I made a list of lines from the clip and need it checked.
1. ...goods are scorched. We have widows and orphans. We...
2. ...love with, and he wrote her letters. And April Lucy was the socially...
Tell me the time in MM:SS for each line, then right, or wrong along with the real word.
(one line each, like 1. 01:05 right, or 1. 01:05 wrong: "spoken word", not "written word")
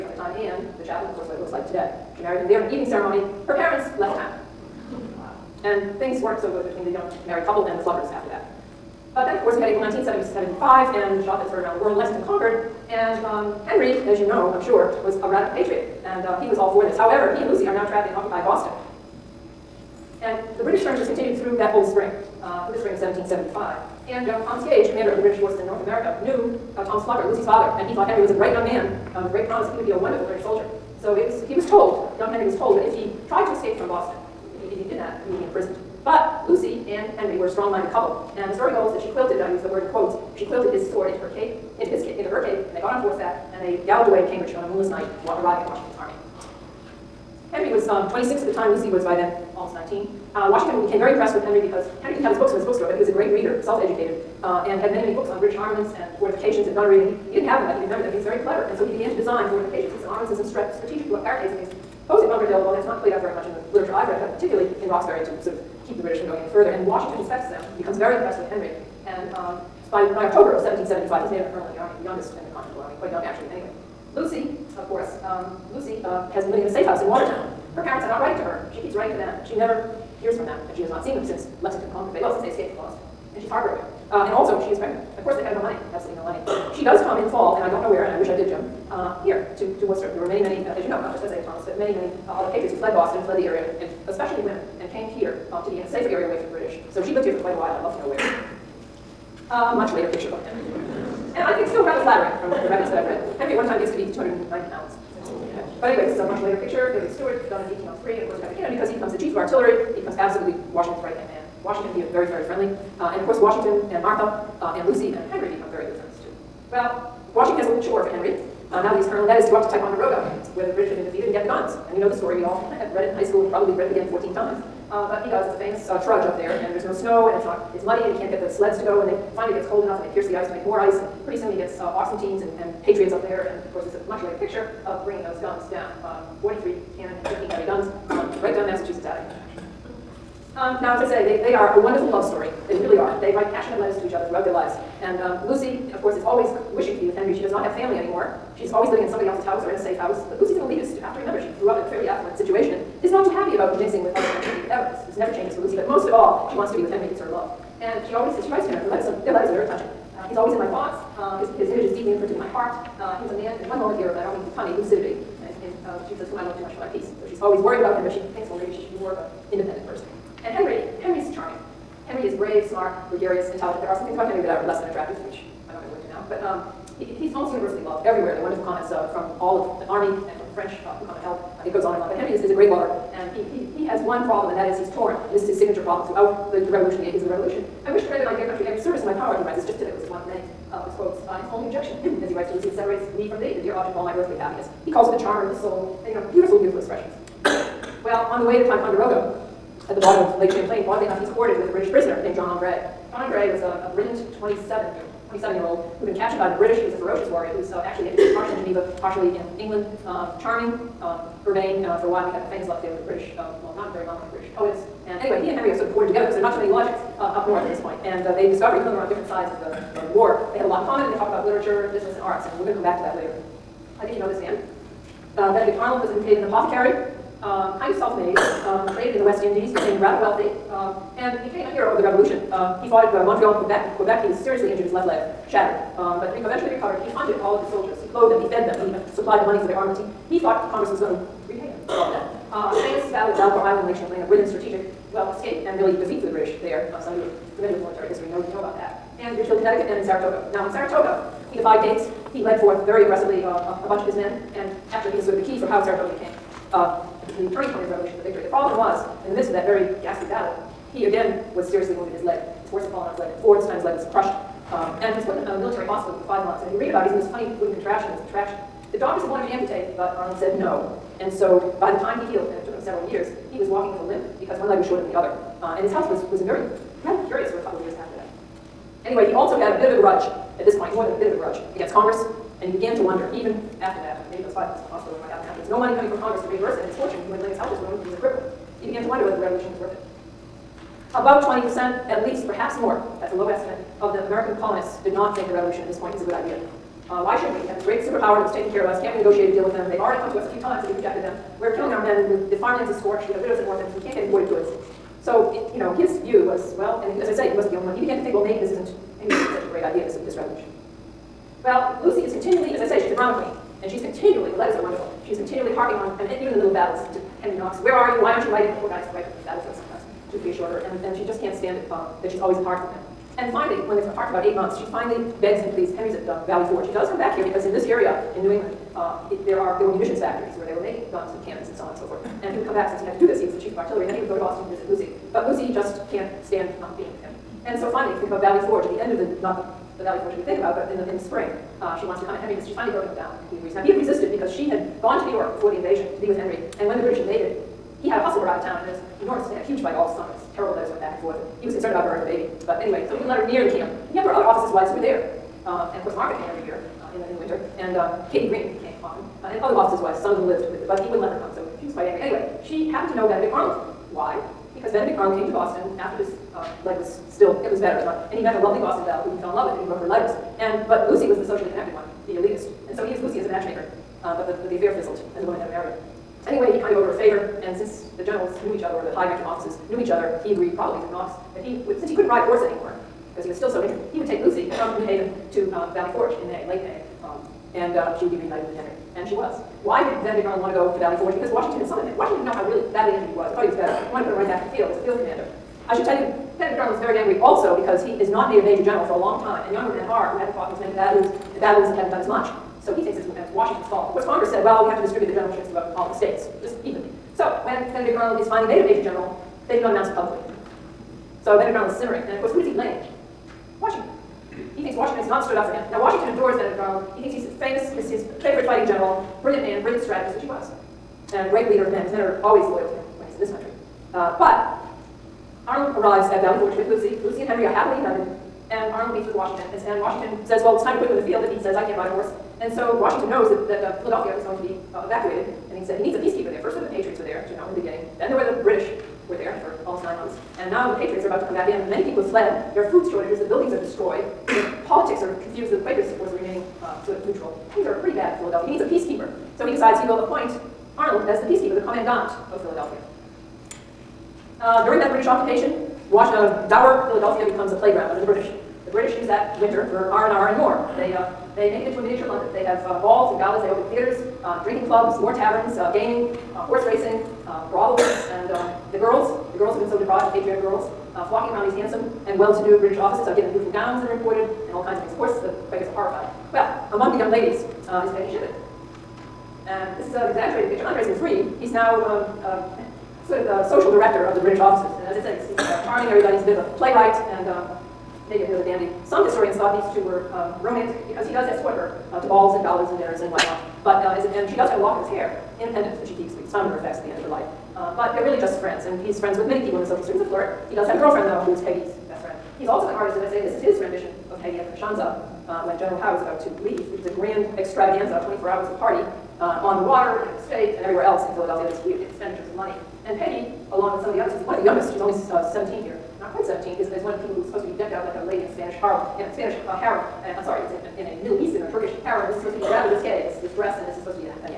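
1. 05:02 wrong: "farmlands", not "goods"
2. 06:09 wrong: "But", not "April".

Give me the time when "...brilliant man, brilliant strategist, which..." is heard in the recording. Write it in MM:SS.
06:59.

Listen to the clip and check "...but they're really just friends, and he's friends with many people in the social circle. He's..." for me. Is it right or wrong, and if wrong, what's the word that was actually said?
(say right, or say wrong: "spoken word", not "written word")
right.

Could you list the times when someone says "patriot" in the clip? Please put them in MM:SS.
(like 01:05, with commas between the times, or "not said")
00:15, 01:32, 02:12, 07:16, 07:20, 07:50.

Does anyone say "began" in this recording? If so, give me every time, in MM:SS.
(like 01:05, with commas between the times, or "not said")
00:58, 04:42, 04:48, 05:08.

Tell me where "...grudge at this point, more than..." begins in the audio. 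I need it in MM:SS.
04:40.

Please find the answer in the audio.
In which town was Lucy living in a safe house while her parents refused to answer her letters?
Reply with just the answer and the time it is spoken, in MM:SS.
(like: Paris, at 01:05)
Watertown, at 01:17.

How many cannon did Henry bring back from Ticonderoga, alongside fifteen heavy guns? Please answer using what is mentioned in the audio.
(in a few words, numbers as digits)
43.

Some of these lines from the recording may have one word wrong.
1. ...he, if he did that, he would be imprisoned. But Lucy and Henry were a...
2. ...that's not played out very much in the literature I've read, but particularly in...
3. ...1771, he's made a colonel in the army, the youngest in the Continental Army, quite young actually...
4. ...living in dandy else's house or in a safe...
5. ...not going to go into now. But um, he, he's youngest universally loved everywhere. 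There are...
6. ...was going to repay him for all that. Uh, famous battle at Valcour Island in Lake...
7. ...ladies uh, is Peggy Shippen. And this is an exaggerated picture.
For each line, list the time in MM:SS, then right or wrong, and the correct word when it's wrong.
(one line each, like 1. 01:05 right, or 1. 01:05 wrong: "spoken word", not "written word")
1. 00:34 right
2. 01:02 right
3. 01:10 wrong: "1775", not "1771"
4. 02:28 wrong: "somebody", not "dandy"
5. 02:55 wrong: "almost", not "youngest"
6. 04:00 right
7. 07:57 right.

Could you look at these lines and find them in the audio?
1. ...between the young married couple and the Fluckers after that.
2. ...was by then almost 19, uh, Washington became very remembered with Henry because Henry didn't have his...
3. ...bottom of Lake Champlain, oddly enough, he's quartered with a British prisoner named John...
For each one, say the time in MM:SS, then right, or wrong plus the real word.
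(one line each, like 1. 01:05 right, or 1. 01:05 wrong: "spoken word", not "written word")
1. 00:06 right
2. 00:48 wrong: "impressed", not "remembered"
3. 03:19 right.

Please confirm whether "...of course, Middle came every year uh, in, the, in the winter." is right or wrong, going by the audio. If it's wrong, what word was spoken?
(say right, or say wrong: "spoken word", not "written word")
wrong: "Martha", not "Middle".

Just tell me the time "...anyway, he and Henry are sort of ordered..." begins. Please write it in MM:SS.
03:35.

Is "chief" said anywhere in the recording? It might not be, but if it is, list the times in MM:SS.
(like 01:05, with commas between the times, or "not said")
01:49, 05:33.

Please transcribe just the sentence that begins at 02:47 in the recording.
So she's always worried about him, but she thinks, well, maybe she should be more of an independent person.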